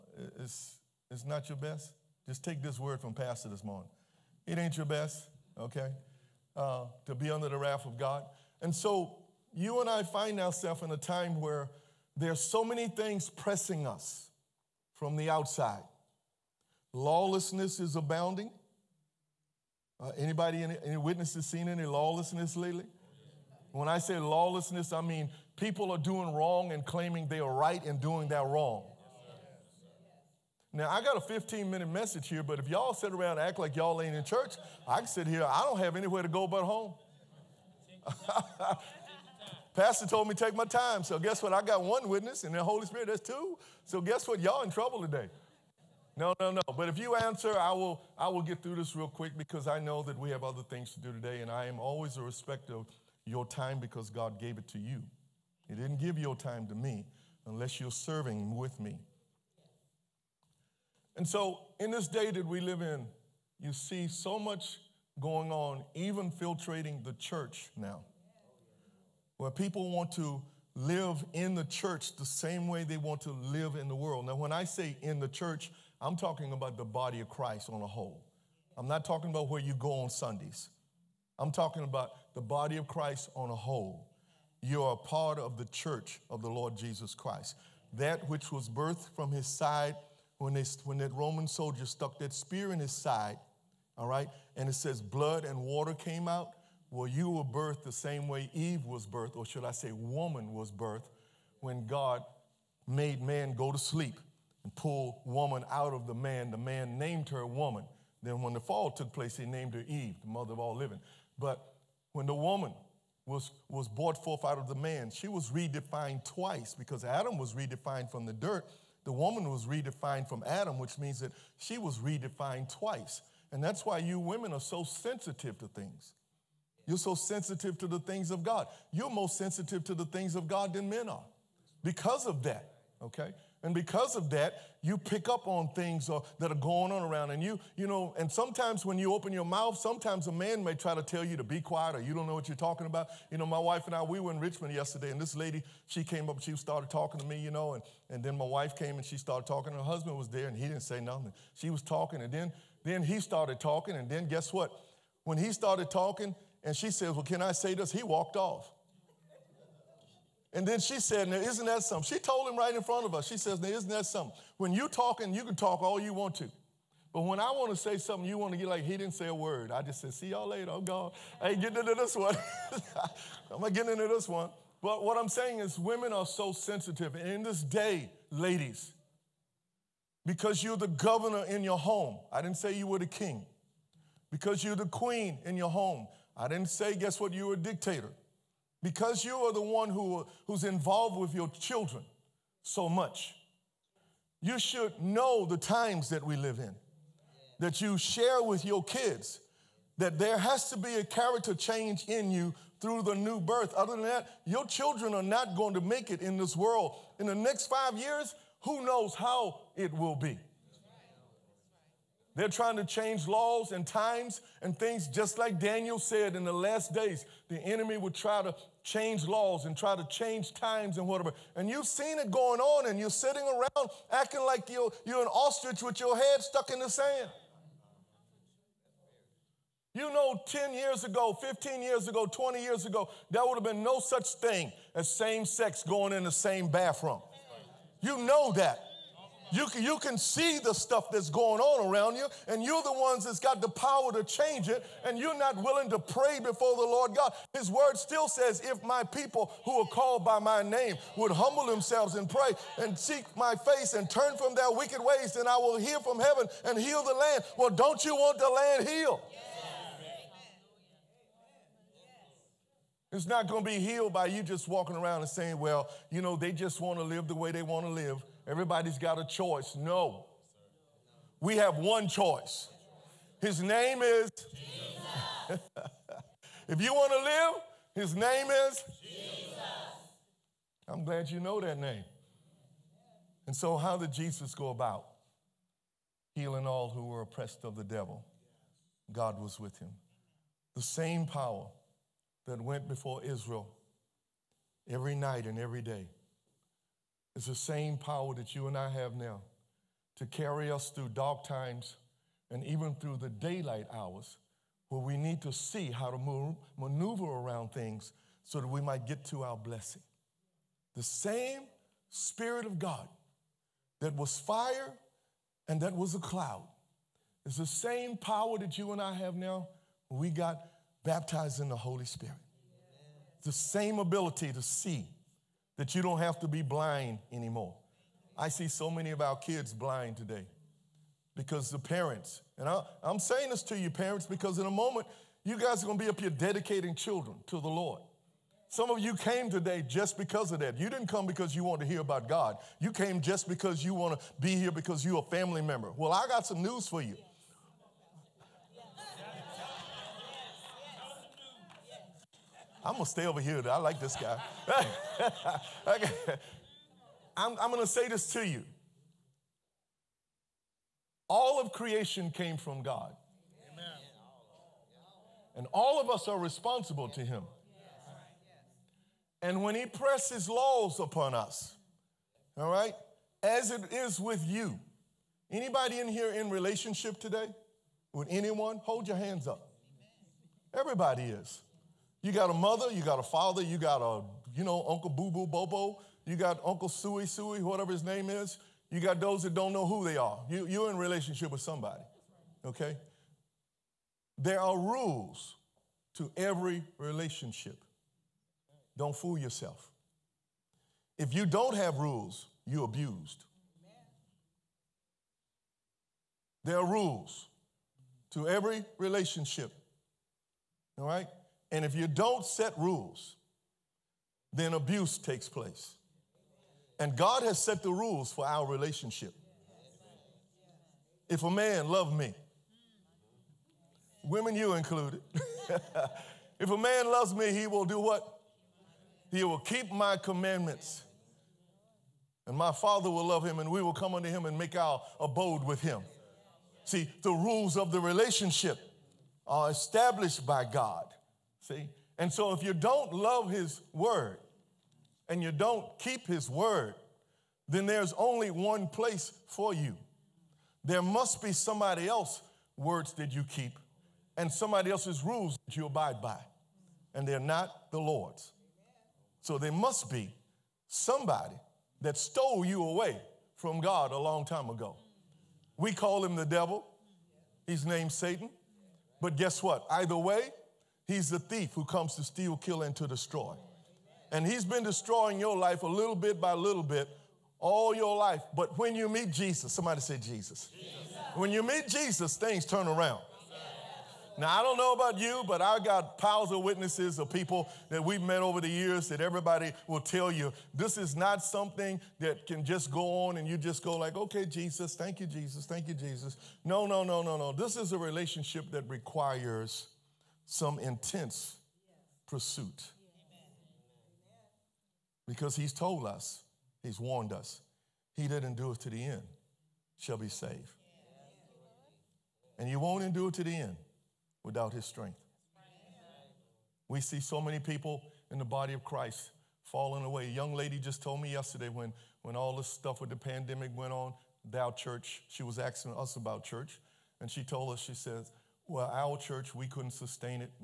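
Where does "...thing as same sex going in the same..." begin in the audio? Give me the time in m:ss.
3:54.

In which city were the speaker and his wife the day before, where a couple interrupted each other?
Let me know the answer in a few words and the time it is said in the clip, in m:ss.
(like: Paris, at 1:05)
Richmond, at 2:24.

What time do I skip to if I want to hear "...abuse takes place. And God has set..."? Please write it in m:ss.
6:54.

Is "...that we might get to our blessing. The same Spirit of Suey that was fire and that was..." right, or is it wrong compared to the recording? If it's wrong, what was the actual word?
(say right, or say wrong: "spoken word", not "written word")
wrong: "God", not "Suey".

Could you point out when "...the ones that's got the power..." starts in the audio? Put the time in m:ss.
4:02.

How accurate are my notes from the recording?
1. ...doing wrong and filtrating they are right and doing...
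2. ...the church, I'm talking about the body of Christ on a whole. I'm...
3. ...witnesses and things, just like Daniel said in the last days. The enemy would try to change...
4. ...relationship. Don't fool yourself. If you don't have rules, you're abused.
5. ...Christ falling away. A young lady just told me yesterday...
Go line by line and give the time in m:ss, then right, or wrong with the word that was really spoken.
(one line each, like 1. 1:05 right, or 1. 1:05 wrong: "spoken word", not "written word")
1. 0:25 wrong: "claiming", not "filtrating"
2. 1:15 right
3. 3:33 wrong: "times", not "witnesses"
4. 6:36 right
5. 8:38 right.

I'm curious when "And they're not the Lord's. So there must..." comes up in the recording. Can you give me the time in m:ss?
7:37.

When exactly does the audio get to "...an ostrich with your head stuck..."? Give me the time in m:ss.
3:45.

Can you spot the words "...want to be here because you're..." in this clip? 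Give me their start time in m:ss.
5:43.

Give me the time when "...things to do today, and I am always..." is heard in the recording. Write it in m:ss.
0:50.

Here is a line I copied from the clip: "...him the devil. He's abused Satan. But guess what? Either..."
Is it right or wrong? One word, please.
wrong.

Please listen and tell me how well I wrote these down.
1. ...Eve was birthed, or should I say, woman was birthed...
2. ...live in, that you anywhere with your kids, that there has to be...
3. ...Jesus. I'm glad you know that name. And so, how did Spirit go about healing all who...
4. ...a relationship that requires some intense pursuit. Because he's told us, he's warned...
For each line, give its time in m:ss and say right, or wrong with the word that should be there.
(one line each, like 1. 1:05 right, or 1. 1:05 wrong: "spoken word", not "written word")
1. 1:38 right
2. 3:16 wrong: "share", not "anywhere"
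3. 4:39 wrong: "Jesus", not "Spirit"
4. 8:17 right.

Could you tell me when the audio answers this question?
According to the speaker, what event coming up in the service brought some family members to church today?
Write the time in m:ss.
5:36.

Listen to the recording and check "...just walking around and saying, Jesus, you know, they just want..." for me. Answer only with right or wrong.
wrong.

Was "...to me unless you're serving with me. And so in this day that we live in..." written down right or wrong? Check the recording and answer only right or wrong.
right.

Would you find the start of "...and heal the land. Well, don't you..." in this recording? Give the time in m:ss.
4:16.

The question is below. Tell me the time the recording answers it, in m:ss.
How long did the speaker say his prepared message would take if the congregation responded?
0:31.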